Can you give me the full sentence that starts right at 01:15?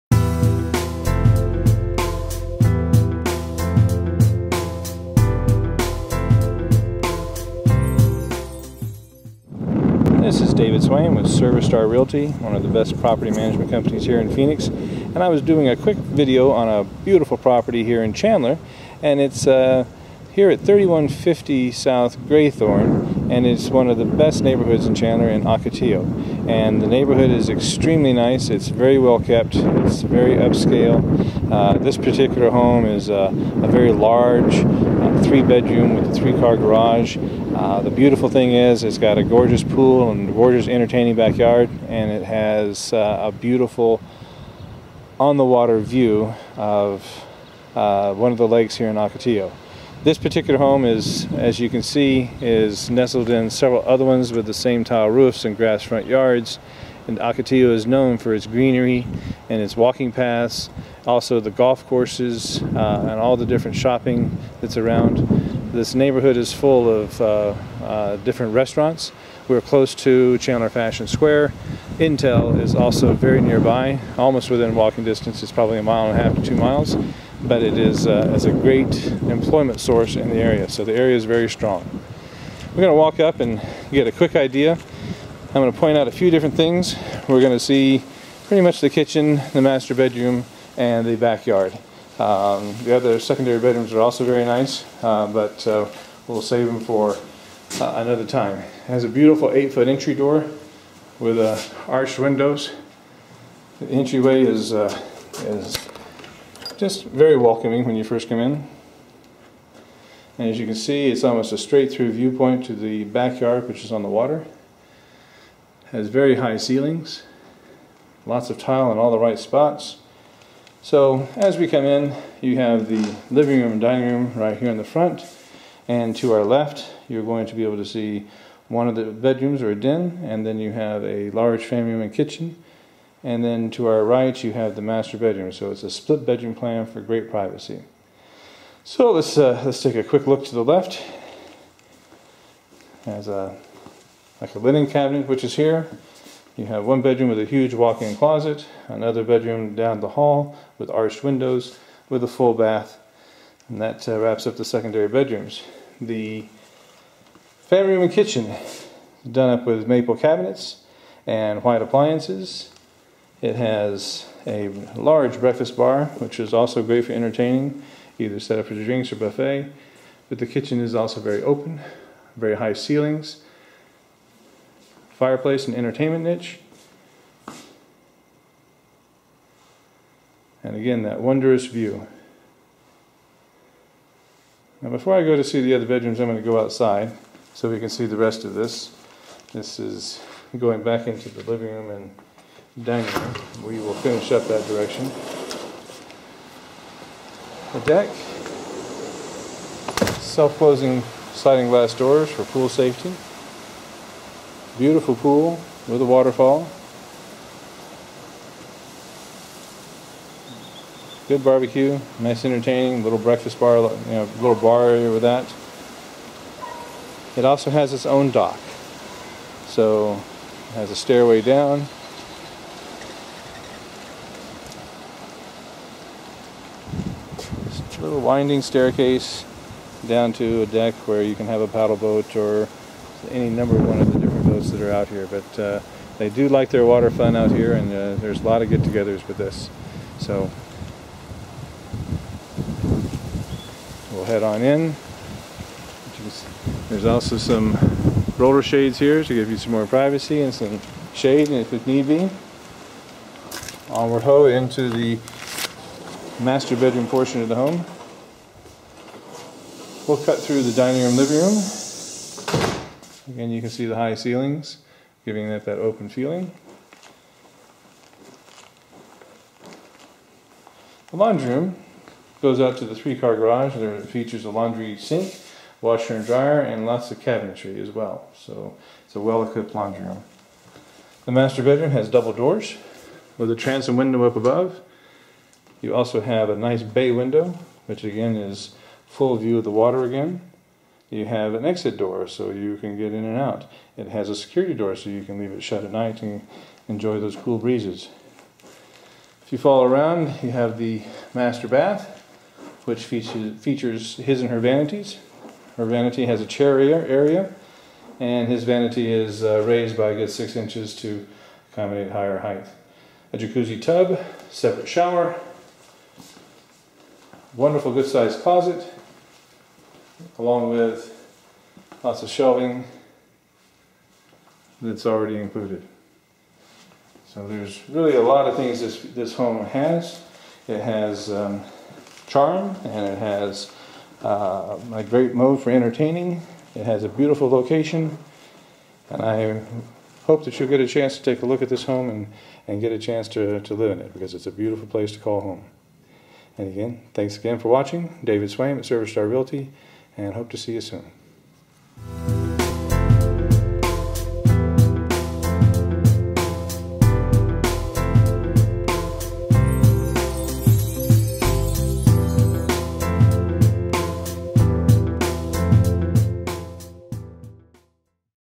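It's probably a mile and a half to two miles, but it is uh, as a great employment source in the area.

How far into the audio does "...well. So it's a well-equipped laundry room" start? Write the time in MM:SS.
04:37.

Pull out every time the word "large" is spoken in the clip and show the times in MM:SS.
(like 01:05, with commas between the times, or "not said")
00:33, 02:11, 02:44.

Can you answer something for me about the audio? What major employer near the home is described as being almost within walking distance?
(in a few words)
Intel.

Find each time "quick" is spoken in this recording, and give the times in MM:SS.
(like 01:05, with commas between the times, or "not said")
00:15, 01:24, 02:20.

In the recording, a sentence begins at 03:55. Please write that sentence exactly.
But uh, they do like their water fun out here, and uh, there's a lot of get-togethers with this.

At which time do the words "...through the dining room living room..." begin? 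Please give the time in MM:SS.
04:20.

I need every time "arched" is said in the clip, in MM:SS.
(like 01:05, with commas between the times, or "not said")
01:41, 02:30.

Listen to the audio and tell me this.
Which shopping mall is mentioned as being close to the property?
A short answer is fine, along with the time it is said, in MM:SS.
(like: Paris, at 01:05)
Chandler Fashion Square, at 01:10.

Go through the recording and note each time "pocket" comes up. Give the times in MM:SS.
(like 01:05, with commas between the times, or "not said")
not said.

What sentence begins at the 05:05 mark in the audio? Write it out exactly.
Her vanity has a chair area, and his vanity is uh, raised by a good six inches to accommodate higher height.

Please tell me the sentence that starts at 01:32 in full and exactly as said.
Um, the other secondary bedrooms are also very nice, uh, but uh, we'll save them for uh, another time.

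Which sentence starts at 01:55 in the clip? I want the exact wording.
It has very high ceilings, lots of tile in all the right spots.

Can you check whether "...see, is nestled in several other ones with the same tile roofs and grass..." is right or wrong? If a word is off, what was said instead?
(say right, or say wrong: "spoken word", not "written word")
right.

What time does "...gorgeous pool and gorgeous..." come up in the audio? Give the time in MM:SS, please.
00:39.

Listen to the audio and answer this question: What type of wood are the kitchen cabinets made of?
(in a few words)
Maple.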